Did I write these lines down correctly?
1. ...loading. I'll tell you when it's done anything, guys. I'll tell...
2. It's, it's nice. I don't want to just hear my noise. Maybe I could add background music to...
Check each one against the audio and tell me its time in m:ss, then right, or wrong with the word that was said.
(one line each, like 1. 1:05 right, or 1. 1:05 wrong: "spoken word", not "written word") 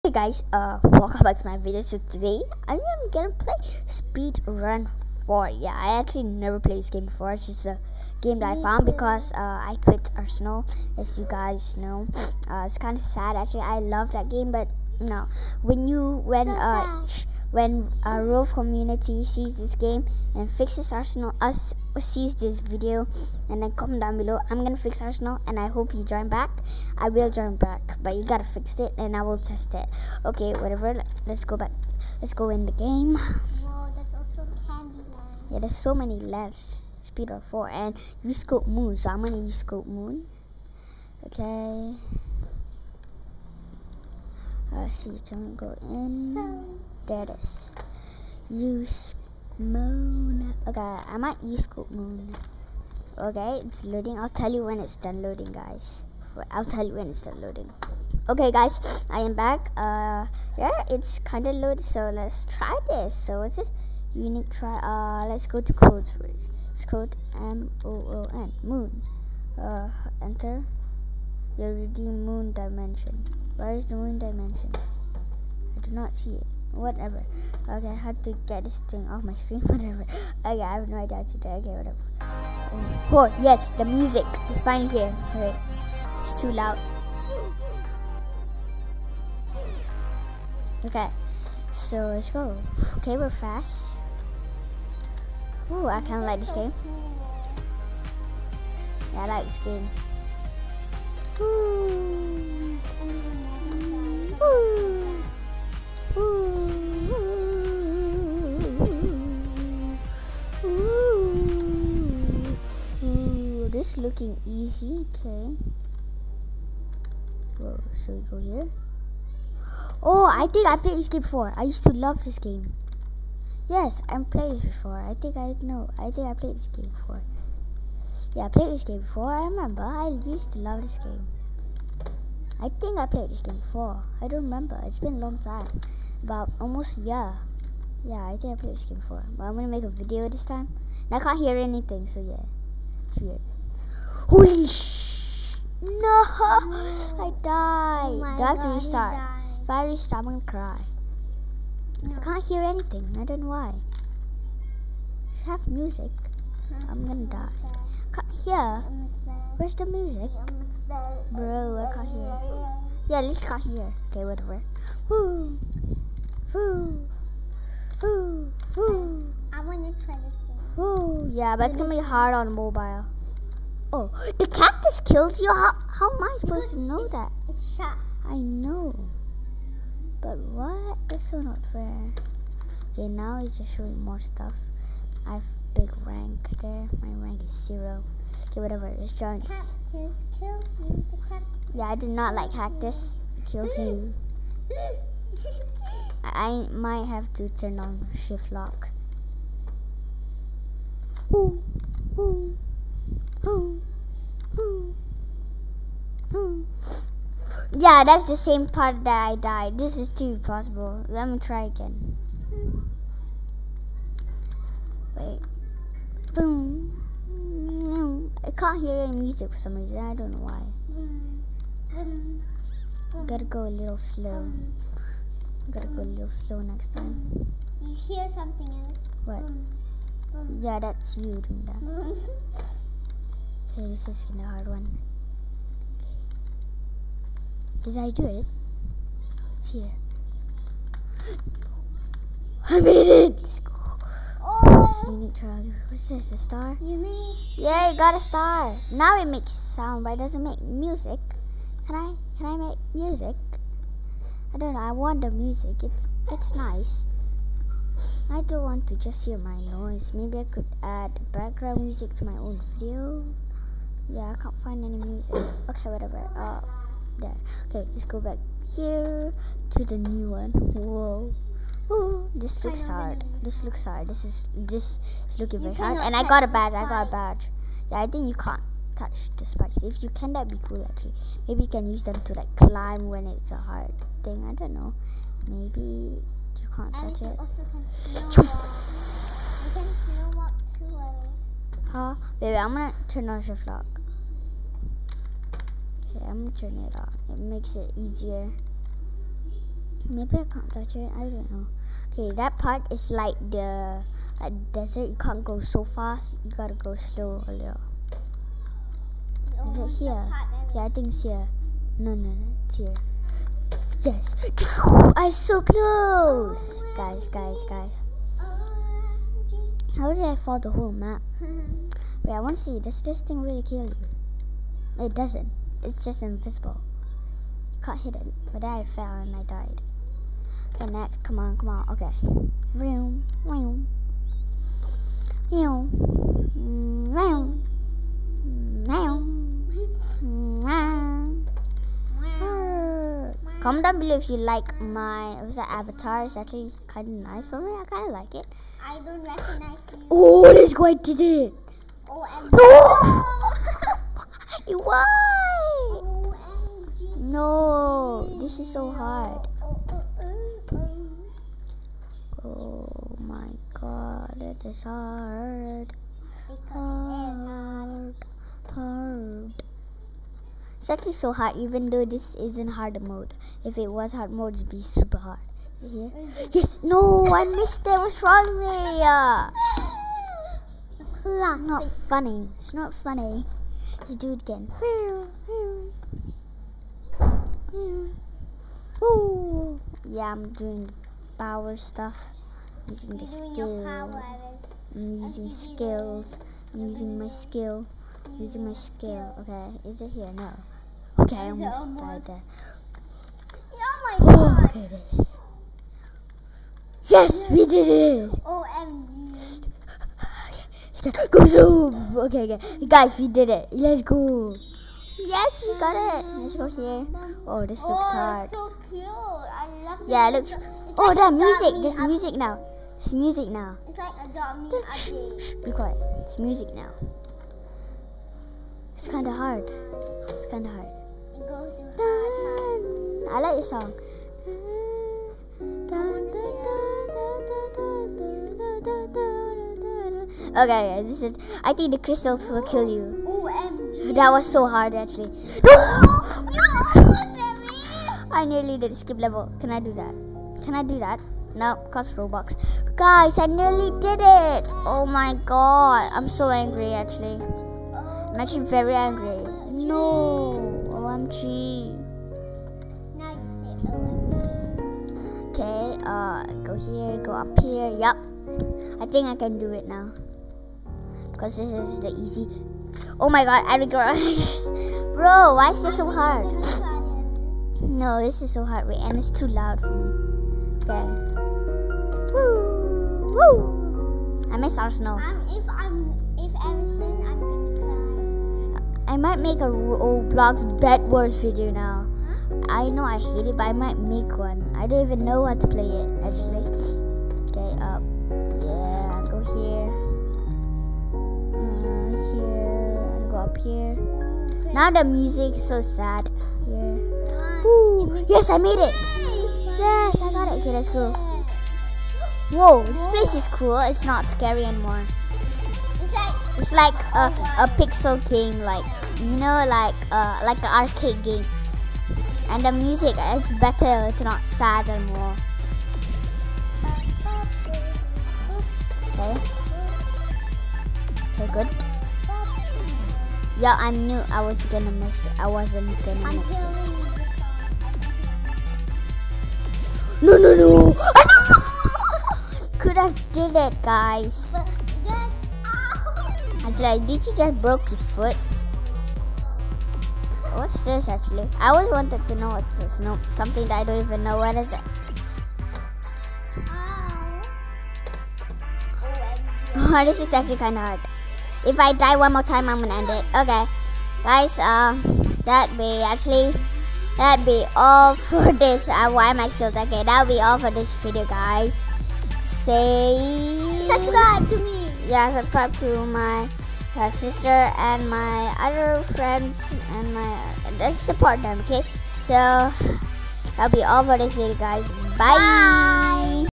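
1. 0:53 wrong: "loading", not "anything"
2. 4:15 right.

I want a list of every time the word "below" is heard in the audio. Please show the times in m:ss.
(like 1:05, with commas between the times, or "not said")
0:24, 5:43.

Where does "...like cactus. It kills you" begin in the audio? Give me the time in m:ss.
3:12.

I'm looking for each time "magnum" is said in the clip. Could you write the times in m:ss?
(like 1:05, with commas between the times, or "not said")
not said.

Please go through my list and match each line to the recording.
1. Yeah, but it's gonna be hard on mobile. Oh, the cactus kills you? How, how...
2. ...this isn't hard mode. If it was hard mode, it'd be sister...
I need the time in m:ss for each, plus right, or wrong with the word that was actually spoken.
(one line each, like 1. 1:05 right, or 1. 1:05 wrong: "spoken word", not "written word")
1. 2:51 right
2. 6:12 wrong: "super", not "sister".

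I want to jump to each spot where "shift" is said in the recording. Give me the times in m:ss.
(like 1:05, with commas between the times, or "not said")
3:18, 4:53.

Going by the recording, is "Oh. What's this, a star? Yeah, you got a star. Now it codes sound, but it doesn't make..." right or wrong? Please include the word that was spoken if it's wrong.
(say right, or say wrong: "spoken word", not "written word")
wrong: "makes", not "codes".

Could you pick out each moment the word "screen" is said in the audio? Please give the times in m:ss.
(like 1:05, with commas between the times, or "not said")
1:19.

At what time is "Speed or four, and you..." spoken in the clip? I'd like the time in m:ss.
0:37.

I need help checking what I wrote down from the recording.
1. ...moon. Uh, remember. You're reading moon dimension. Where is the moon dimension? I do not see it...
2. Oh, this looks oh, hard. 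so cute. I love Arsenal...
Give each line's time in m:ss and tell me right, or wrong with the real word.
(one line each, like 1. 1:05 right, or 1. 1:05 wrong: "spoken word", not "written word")
1. 1:08 wrong: "enter", not "remember"
2. 6:57 wrong: "Yeah", not "Arsenal".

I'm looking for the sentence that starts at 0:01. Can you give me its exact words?
So today, I am gonna play Speed Run 4.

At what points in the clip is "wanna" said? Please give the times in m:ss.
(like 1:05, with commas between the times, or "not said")
2:49.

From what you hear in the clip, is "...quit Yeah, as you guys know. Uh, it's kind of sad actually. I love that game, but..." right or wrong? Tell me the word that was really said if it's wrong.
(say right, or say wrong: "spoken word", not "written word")
wrong: "Arsenal", not "Yeah".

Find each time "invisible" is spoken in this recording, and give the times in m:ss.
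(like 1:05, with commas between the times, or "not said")
5:26.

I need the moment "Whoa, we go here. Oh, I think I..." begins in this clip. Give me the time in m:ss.
1:57.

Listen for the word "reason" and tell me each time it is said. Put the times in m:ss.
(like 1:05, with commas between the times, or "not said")
3:39.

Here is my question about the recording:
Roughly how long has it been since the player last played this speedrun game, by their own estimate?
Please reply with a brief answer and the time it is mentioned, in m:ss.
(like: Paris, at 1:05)
almost a year, at 2:16.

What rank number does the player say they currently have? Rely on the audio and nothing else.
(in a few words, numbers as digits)
0.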